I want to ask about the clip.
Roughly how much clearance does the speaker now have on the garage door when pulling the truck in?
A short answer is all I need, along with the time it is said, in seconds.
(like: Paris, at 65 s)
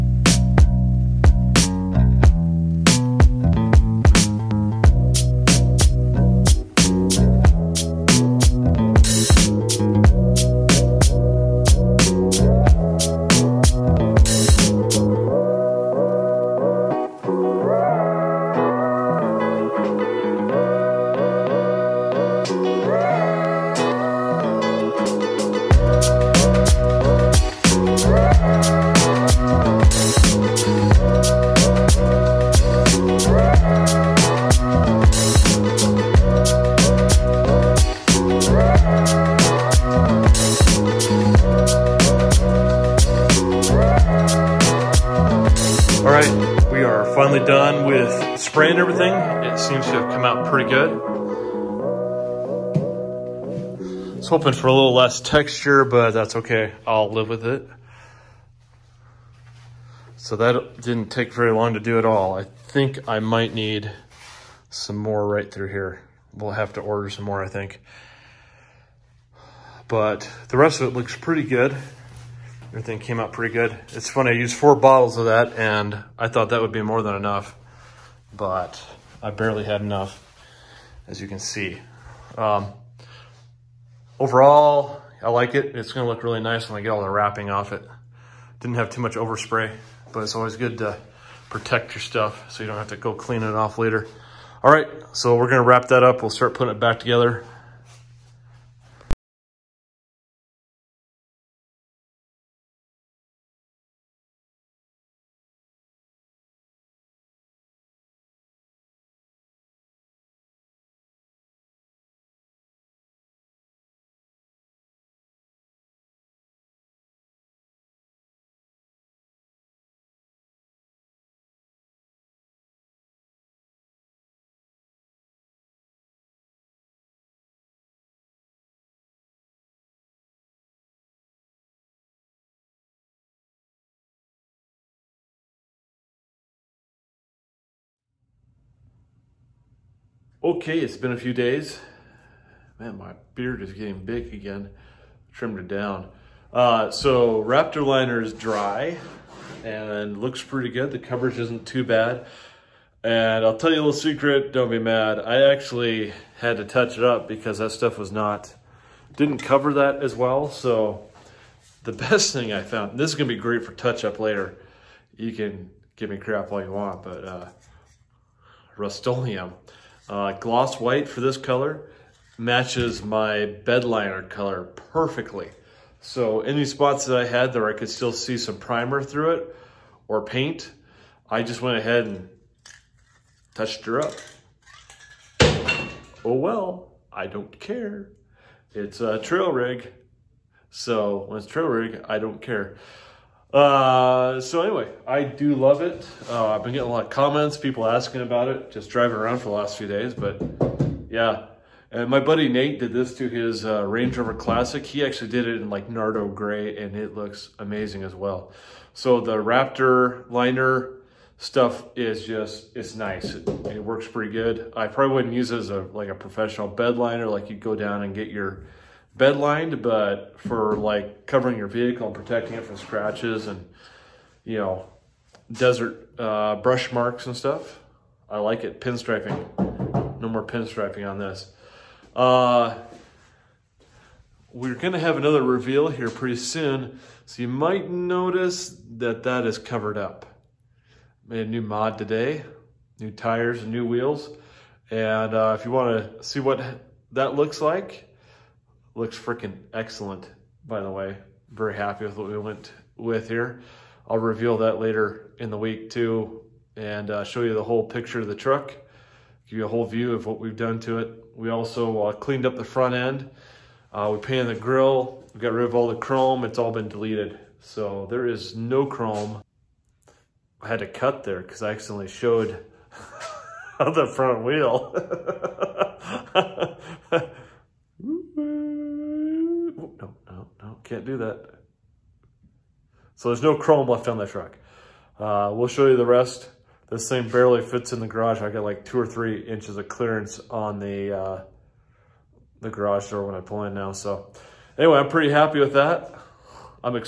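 2 or 3 inches, at 288 s.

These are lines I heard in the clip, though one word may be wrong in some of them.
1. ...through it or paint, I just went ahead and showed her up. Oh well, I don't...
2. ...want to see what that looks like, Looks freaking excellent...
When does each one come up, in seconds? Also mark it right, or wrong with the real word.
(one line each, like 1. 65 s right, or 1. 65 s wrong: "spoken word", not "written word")
1. 179 s wrong: "touched", not "showed"
2. 245 s right.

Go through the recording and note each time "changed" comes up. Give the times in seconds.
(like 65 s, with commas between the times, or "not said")
not said.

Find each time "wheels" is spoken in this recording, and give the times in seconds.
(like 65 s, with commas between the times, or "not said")
243 s, 274 s.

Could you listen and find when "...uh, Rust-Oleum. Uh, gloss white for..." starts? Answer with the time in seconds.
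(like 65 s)
167 s.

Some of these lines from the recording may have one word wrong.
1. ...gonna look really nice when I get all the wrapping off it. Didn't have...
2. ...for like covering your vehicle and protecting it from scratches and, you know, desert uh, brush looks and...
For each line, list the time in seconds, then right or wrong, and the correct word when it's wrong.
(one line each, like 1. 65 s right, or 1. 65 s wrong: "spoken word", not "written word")
1. 85 s right
2. 220 s wrong: "marks", not "looks".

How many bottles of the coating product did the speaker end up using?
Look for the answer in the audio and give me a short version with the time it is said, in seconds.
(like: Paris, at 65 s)
4, at 74 s.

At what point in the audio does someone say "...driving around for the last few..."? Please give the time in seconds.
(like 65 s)
198 s.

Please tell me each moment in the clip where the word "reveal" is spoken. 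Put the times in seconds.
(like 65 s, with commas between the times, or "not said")
235 s, 254 s.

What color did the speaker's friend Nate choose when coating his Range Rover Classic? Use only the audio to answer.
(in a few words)
Nardo gray.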